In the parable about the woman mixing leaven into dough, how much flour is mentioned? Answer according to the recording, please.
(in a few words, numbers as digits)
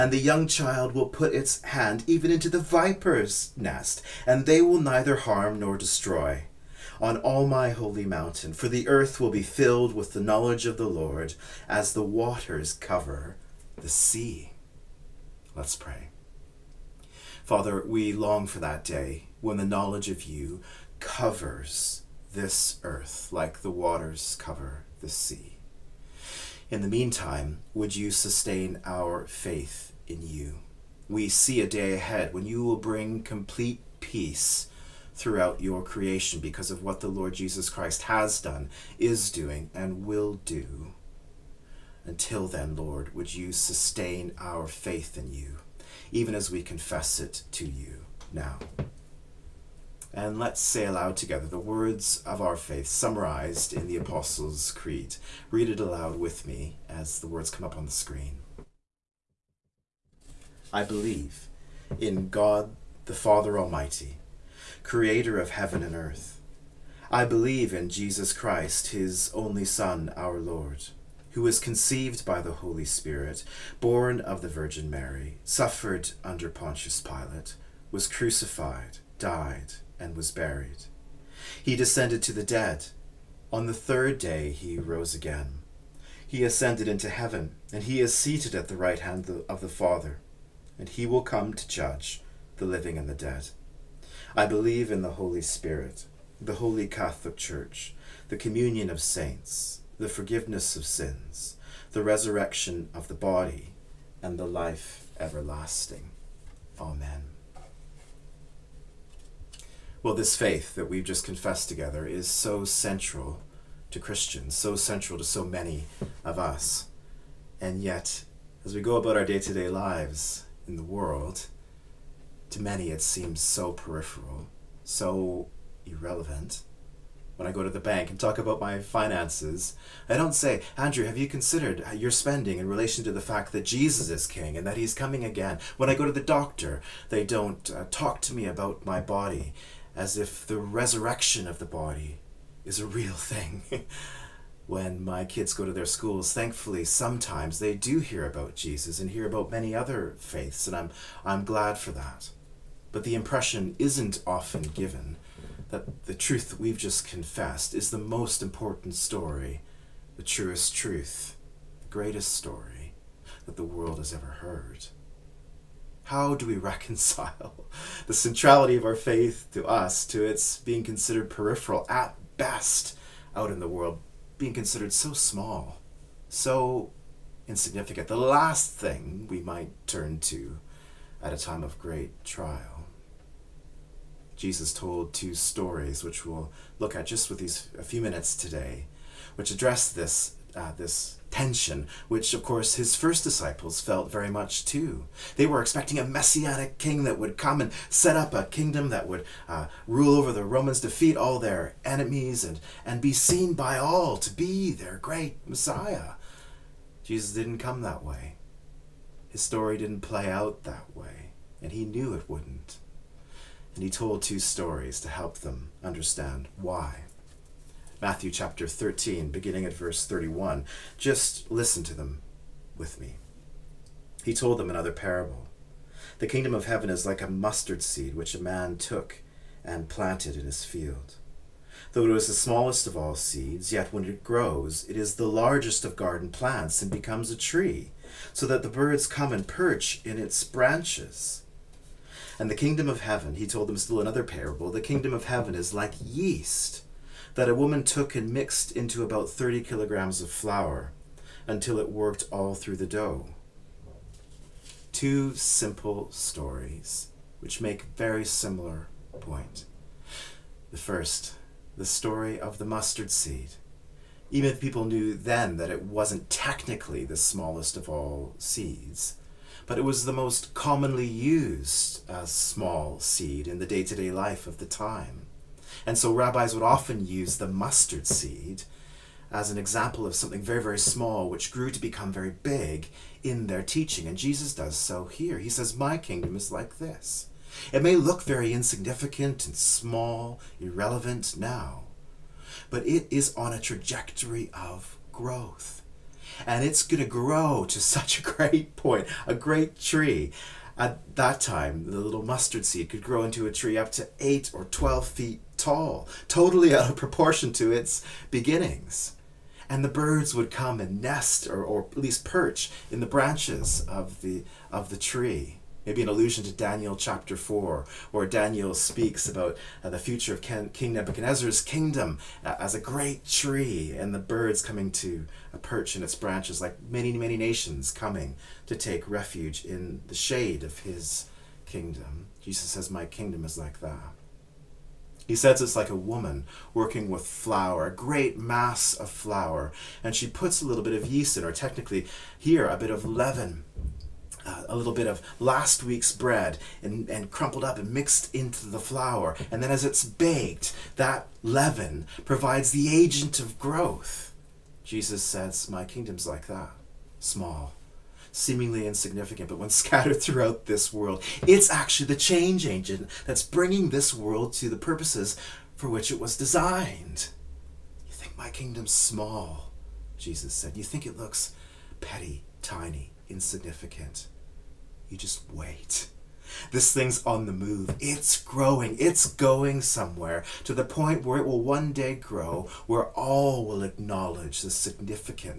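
30 kilograms.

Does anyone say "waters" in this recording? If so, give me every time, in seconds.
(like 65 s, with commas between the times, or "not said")
12 s, 23 s.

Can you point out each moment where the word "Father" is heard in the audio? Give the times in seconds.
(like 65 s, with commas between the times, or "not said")
17 s, 63 s, 89 s.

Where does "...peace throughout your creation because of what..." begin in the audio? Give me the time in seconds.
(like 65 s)
33 s.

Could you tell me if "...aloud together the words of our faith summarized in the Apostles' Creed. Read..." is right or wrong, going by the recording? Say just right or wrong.
right.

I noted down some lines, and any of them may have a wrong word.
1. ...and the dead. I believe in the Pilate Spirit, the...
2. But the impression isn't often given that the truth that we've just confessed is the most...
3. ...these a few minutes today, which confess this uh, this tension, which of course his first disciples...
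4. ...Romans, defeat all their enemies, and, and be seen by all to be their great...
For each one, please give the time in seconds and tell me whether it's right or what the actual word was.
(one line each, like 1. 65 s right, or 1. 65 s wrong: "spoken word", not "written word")
1. 92 s wrong: "Holy", not "Pilate"
2. 152 s right
3. 187 s wrong: "address", not "confess"
4. 200 s right.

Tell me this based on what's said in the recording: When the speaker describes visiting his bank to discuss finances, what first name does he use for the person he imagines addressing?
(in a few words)
Andrew.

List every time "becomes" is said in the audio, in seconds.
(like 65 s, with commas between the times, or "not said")
236 s, 281 s.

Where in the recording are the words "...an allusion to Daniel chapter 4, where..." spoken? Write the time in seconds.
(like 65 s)
316 s.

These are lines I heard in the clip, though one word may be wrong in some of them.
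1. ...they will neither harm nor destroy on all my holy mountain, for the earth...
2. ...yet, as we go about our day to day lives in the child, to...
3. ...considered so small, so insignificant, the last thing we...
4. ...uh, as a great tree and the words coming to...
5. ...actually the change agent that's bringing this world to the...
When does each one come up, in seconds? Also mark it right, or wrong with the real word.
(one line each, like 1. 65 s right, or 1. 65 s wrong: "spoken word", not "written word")
1. 4 s right
2. 117 s wrong: "world", not "child"
3. 174 s right
4. 322 s wrong: "birds", not "words"
5. 361 s right.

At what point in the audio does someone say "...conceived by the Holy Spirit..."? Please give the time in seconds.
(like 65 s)
71 s.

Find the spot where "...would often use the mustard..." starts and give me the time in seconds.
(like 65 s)
276 s.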